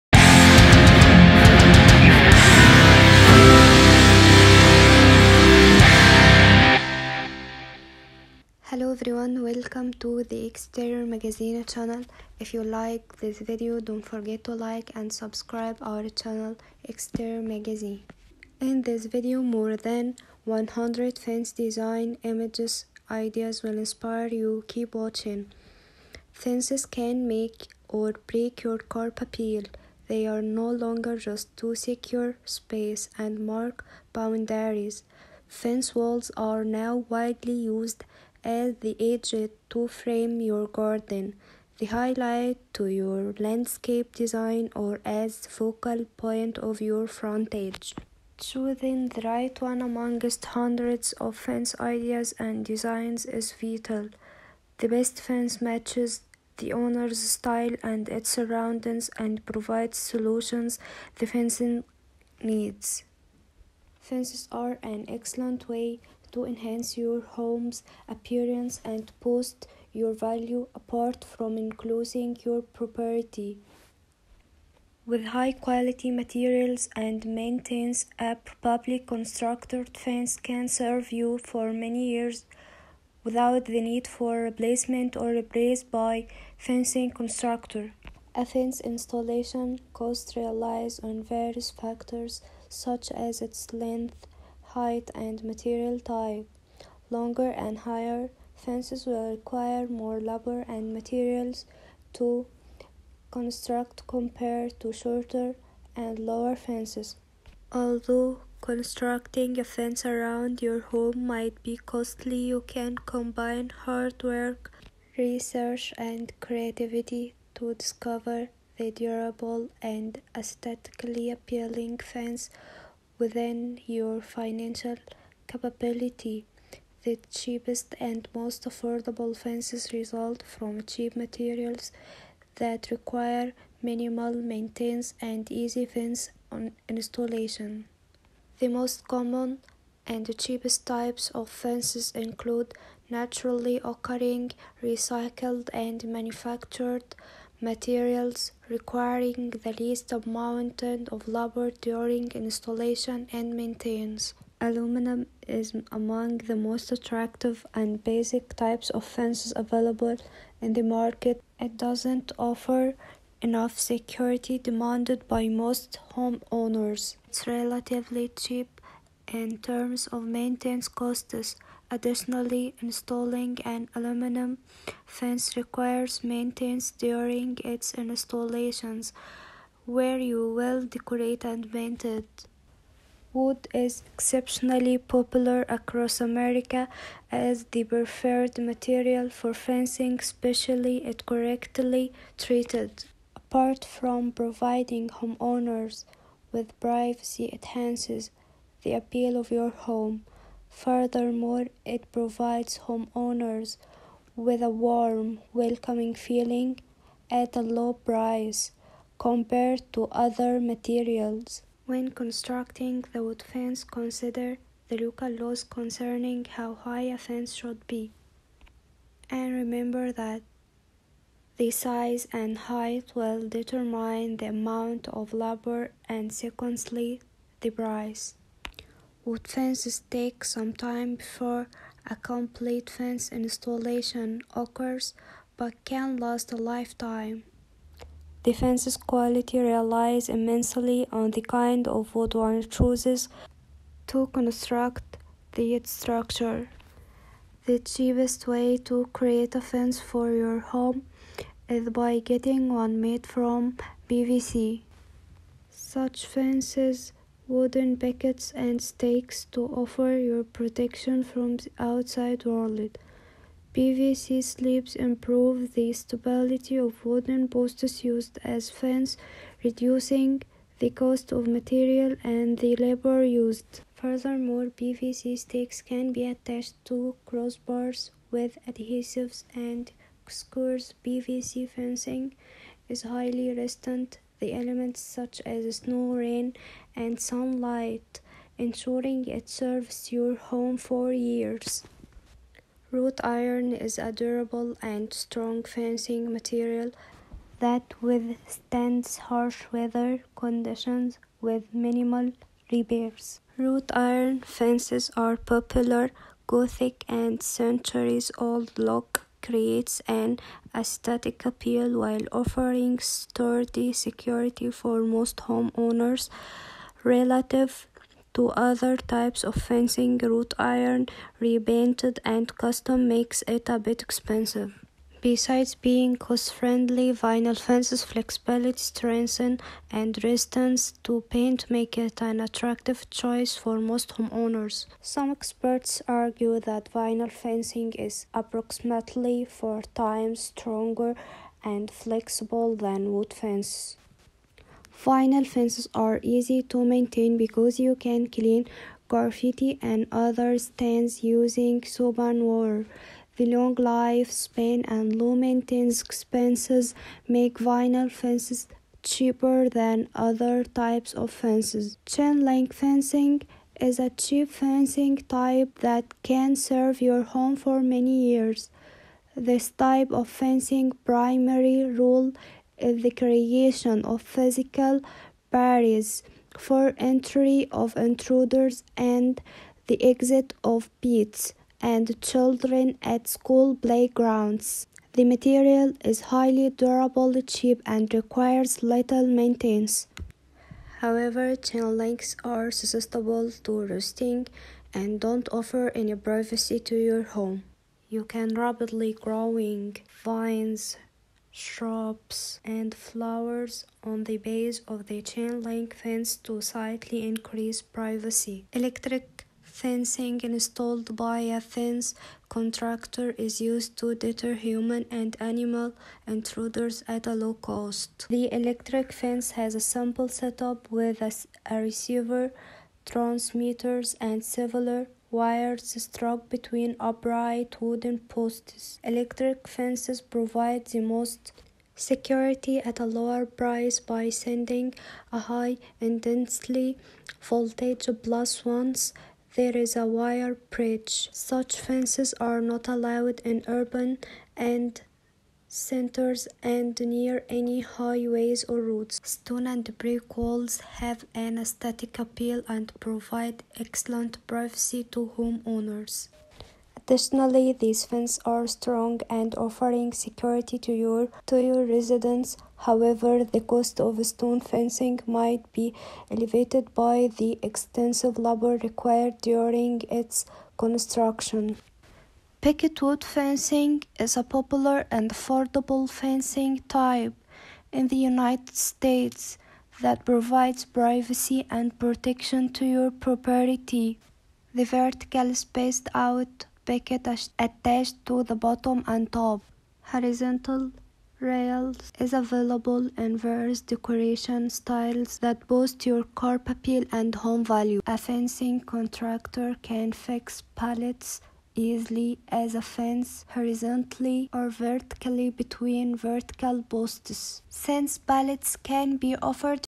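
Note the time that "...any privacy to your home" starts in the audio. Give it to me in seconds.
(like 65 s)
395 s.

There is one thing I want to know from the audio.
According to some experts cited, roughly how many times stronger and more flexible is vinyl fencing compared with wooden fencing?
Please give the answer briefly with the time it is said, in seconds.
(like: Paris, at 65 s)
4 times, at 339 s.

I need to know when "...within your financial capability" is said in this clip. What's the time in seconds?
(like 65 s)
123 s.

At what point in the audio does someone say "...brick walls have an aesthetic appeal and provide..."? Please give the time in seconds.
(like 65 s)
449 s.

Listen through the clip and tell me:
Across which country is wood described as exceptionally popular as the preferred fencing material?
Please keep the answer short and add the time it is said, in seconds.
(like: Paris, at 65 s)
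America, at 186 s.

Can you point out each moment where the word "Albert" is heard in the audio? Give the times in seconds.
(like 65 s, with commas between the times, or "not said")
not said.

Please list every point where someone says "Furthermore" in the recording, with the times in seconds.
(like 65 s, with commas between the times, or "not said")
200 s, 273 s.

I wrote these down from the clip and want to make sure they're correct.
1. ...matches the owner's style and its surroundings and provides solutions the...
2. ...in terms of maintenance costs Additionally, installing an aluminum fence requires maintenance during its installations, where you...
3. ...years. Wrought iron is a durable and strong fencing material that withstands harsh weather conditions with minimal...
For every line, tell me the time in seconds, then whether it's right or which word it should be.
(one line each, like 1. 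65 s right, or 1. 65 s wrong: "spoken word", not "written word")
1. 55 s right
2. 169 s right
3. 291 s right.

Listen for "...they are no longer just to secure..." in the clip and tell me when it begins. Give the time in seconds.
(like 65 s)
30 s.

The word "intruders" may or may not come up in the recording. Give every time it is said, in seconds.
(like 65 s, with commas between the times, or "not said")
377 s, 416 s.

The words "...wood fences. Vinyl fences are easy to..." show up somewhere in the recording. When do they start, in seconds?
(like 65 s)
343 s.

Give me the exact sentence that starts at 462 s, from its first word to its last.
However, the cost of stone fencing might be elevated by the extensive labor required during its construction.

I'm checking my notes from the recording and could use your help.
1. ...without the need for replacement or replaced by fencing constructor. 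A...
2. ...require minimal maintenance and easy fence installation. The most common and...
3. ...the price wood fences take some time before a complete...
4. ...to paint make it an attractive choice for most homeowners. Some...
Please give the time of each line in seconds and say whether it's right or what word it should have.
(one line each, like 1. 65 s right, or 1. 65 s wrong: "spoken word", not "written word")
1. 83 s right
2. 132 s right
3. 227 s right
4. 331 s right.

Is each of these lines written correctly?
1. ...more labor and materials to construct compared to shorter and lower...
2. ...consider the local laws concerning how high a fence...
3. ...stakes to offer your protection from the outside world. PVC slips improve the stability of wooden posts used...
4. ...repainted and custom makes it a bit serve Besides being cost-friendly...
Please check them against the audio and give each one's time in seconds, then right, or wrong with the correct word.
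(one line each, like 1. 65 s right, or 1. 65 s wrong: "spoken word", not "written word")
1. 99 s right
2. 213 s right
3. 258 s right
4. 321 s wrong: "expensive", not "serve".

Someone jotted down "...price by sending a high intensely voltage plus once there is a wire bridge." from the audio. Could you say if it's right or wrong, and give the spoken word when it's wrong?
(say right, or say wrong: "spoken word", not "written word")
right.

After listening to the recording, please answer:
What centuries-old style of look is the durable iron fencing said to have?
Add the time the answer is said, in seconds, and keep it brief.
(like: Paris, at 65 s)
Gothic, at 306 s.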